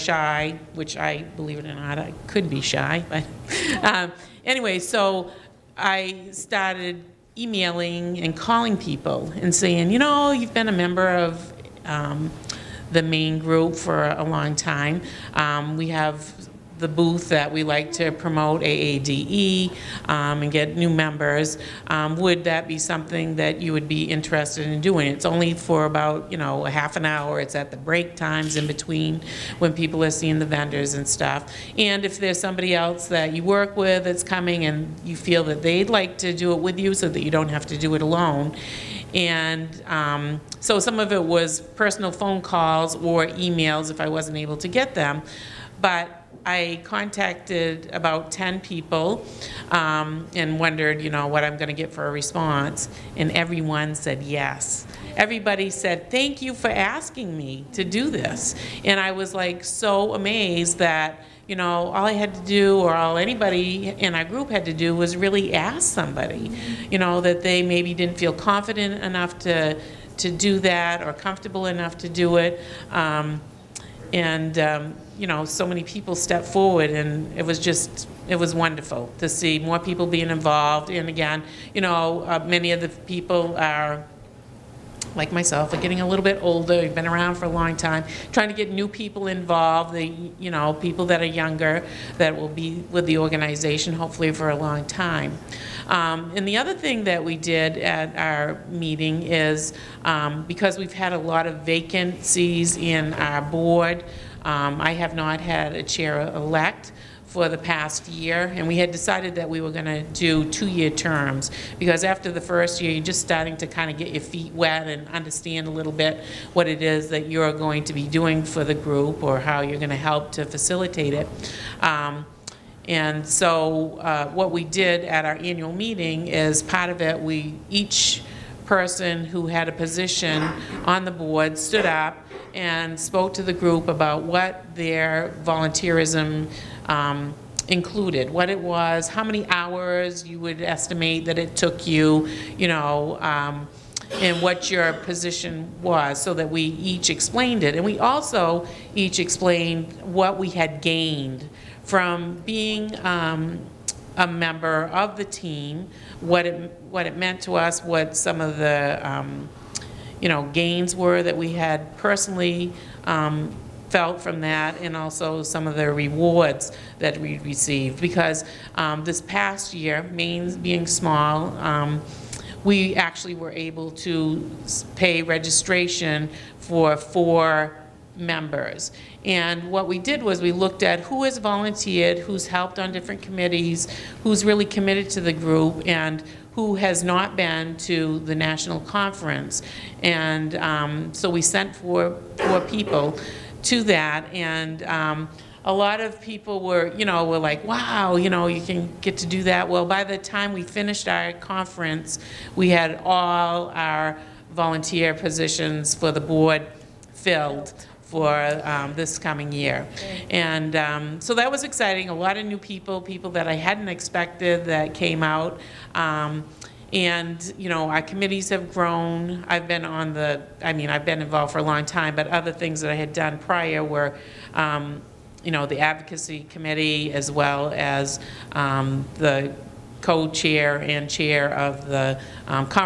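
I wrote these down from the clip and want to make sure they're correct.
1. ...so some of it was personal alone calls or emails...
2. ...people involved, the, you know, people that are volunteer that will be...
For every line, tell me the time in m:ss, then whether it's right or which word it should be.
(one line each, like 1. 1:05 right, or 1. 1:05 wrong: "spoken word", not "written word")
1. 0:40 wrong: "phone", not "alone"
2. 1:28 wrong: "younger", not "volunteer".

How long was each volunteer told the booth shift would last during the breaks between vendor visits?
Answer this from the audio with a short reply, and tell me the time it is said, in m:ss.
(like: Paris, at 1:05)
half an hour, at 0:26.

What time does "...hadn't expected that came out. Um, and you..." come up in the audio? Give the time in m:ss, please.
3:33.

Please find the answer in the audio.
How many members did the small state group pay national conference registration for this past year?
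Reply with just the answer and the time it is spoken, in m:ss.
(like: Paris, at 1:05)
4, at 2:56.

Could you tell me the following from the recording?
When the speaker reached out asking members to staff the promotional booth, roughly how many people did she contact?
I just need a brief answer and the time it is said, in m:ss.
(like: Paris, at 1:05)
10, at 0:47.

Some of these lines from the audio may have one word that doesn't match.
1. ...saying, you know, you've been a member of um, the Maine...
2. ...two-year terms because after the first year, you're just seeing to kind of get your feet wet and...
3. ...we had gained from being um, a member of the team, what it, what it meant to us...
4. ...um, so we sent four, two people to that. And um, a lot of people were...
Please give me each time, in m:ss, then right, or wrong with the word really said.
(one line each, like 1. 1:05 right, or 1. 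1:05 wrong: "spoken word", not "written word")
1. 0:09 right
2. 1:50 wrong: "starting", not "seeing"
3. 2:30 right
4. 3:10 wrong: "four", not "two".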